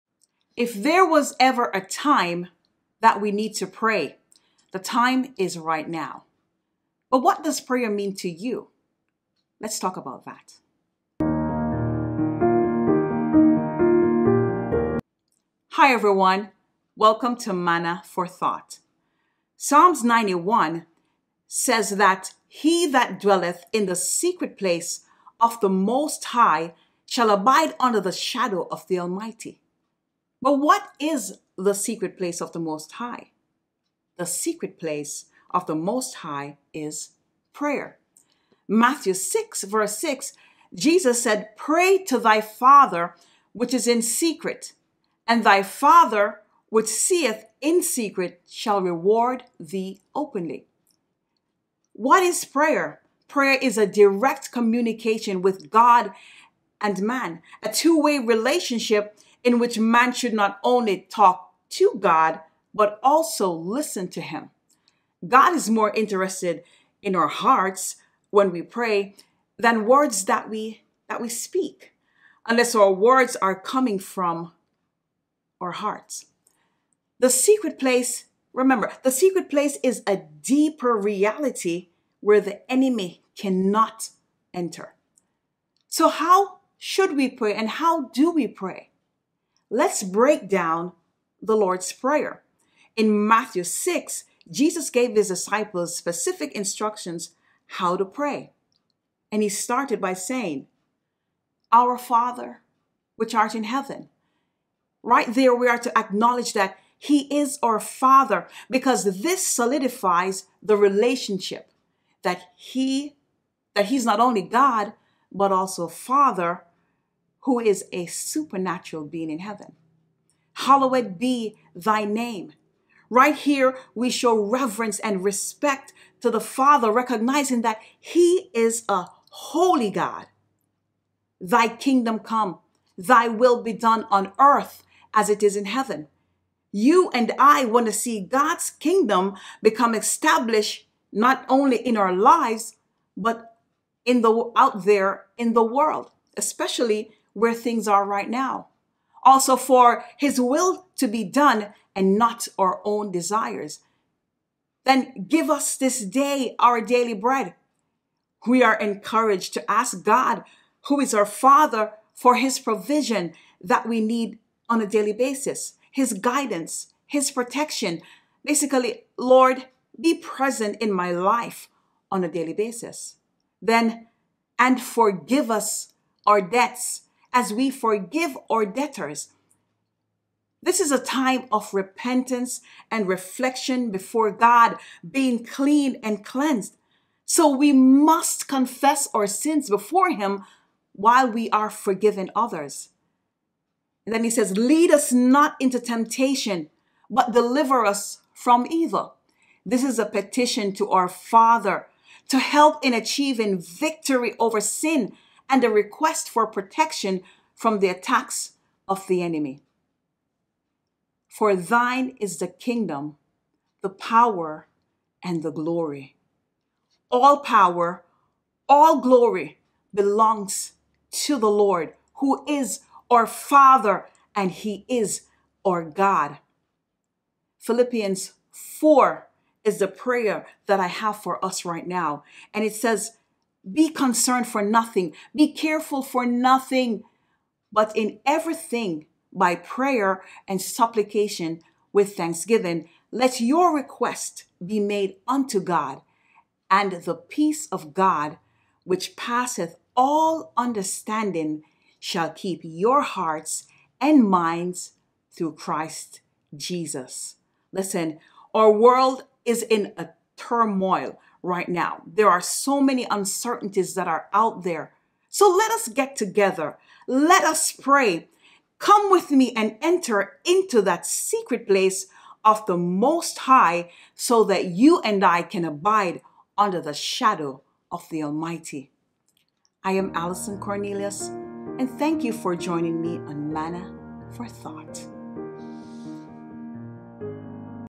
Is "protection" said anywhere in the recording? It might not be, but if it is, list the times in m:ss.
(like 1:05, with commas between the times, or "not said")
2:47, 3:26.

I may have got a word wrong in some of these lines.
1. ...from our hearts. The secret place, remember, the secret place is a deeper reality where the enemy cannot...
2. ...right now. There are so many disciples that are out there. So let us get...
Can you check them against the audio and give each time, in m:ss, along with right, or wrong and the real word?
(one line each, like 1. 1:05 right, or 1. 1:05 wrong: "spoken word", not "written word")
1. 1:13 right
2. 4:21 wrong: "uncertainties", not "disciples".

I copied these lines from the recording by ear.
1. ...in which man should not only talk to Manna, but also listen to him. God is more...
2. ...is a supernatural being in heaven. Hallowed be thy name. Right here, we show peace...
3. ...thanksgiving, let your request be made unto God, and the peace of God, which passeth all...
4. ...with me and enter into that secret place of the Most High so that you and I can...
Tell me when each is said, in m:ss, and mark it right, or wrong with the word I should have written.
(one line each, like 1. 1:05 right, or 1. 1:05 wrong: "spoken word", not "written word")
1. 0:59 wrong: "God", not "Manna"
2. 1:57 wrong: "reverence", not "peace"
3. 4:02 right
4. 4:29 right.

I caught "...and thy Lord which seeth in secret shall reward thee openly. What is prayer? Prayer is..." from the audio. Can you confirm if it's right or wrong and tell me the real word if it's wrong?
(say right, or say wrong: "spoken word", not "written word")
wrong: "Father", not "Lord".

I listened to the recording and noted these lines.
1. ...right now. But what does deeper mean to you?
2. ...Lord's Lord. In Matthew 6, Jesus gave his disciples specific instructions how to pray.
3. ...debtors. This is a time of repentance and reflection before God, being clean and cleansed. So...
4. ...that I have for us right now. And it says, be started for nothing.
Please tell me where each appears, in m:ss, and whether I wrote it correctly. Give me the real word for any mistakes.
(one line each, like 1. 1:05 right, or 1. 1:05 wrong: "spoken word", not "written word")
1. 0:05 wrong: "prayer", not "deeper"
2. 1:31 wrong: "Prayer", not "Lord"
3. 2:58 right
4. 3:50 wrong: "concerned", not "started".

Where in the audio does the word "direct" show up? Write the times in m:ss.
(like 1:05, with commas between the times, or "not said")
0:53.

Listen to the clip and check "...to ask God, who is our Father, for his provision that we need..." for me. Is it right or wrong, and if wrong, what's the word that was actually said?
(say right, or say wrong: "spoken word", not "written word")
right.